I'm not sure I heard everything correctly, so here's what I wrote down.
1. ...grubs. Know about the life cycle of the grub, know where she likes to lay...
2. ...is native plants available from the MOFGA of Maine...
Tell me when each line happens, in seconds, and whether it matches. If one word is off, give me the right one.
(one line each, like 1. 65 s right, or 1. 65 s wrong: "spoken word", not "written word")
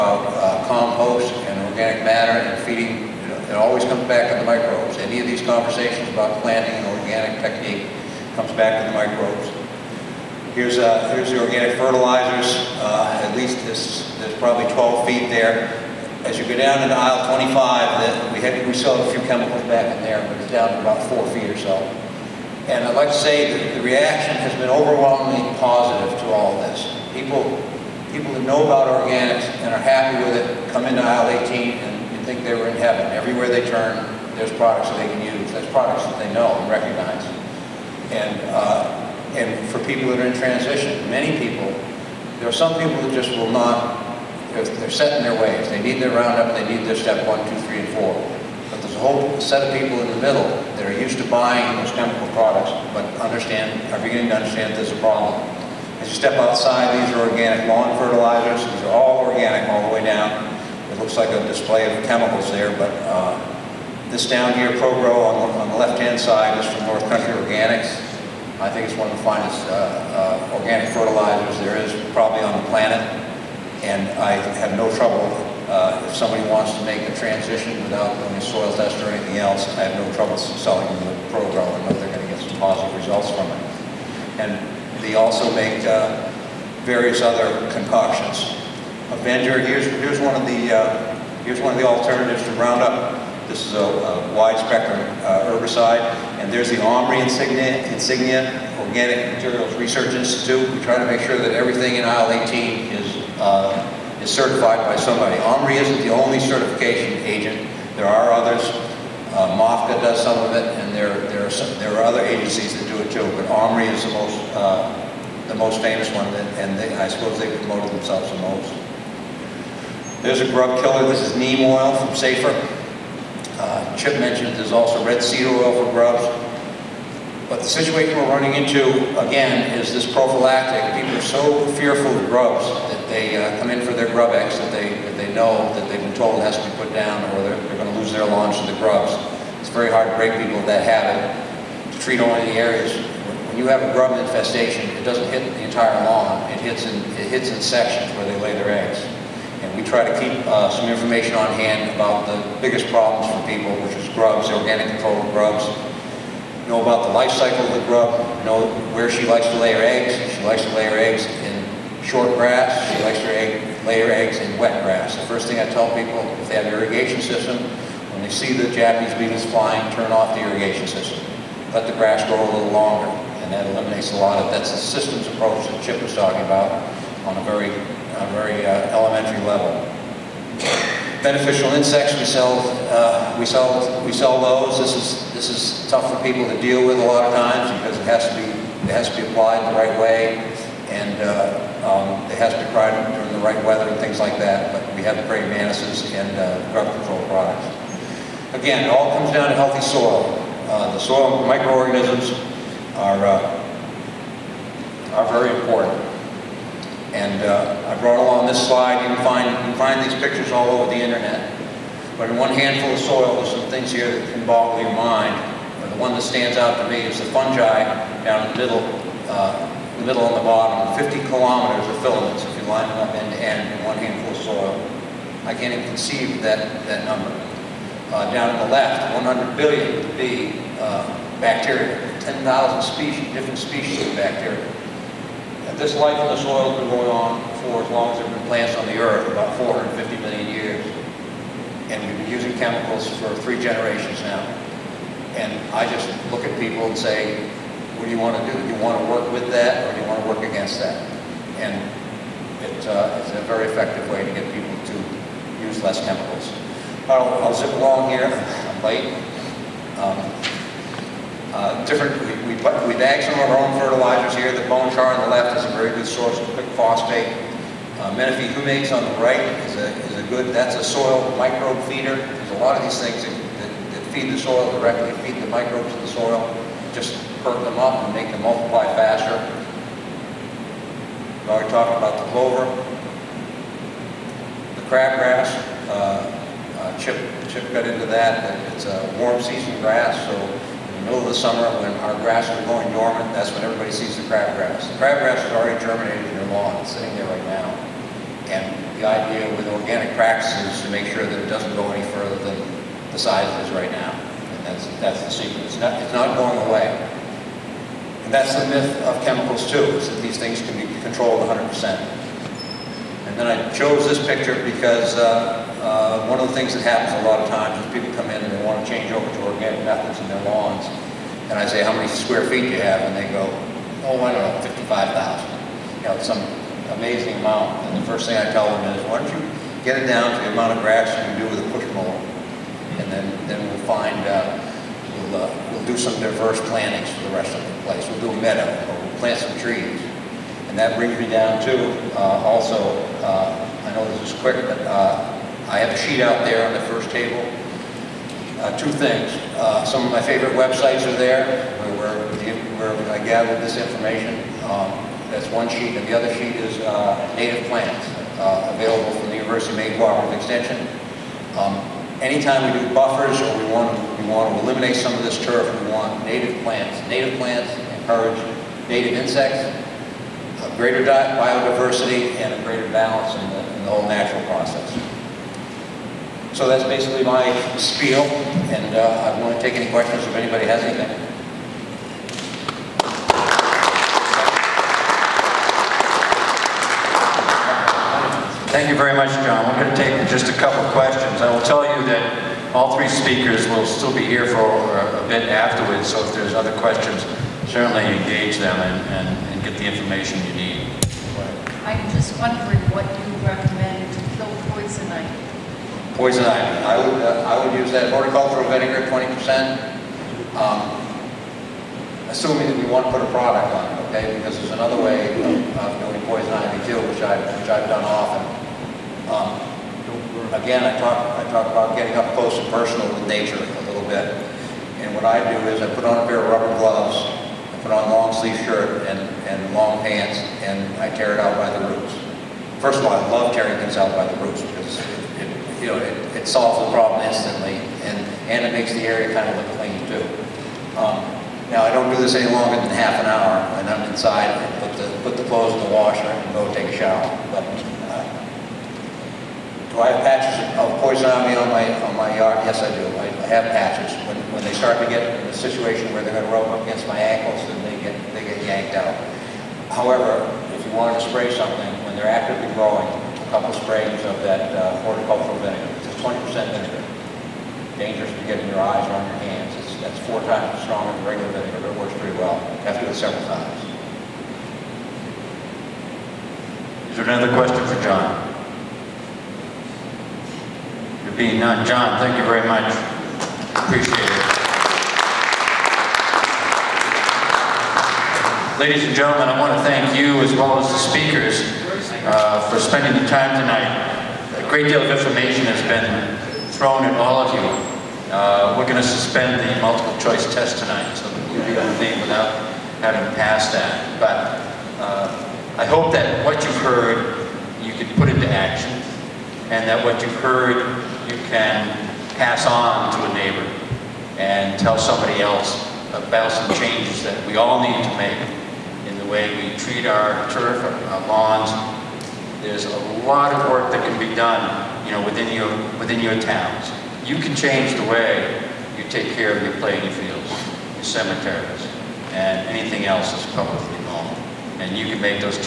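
1. 155 s right
2. 356 s wrong: "University", not "MOFGA".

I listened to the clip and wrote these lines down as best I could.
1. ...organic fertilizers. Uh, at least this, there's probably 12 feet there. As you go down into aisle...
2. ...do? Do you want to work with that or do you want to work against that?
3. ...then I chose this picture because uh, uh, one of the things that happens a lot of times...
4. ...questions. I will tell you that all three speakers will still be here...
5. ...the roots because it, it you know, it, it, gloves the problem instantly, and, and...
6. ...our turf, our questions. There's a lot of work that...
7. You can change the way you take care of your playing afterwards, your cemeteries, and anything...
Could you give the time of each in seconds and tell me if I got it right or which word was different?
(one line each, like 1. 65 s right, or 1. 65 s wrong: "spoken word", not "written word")
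1. 11 s right
2. 248 s right
3. 313 s right
4. 390 s right
5. 434 s wrong: "solves", not "gloves"
6. 520 s wrong: "lawns", not "questions"
7. 527 s wrong: "fields", not "afterwards".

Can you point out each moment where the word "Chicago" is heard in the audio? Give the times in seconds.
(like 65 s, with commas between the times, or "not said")
not said.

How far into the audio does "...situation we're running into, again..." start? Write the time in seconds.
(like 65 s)
127 s.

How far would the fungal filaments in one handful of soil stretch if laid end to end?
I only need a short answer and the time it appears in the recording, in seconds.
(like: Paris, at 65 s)
50 kilometers, at 221 s.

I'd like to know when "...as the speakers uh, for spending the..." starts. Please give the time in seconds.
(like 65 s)
490 s.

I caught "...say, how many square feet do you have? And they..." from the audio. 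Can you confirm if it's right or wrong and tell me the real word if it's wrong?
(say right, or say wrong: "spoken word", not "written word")
right.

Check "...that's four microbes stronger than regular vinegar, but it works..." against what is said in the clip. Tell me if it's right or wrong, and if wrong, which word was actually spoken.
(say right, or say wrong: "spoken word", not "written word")
wrong: "times", not "microbes".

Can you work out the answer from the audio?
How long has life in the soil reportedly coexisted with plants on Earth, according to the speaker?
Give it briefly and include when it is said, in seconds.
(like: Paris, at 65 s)
450 million years, at 239 s.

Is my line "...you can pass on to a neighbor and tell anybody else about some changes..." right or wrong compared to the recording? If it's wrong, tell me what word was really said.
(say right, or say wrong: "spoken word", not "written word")
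wrong: "somebody", not "anybody".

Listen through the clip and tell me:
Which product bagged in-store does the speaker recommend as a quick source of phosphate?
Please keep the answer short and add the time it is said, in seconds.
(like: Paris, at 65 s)
Bone char, at 264 s.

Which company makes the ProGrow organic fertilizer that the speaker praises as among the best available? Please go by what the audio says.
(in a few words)
North Country Organics.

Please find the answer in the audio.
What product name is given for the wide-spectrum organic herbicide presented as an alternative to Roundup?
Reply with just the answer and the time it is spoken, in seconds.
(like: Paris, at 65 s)
Avenger, at 89 s.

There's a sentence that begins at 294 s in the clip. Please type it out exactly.
The crabgrass is already germinated in their lawn, it's sitting there right now.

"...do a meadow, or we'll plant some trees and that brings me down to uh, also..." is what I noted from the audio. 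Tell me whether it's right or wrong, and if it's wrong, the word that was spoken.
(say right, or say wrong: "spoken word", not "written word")
right.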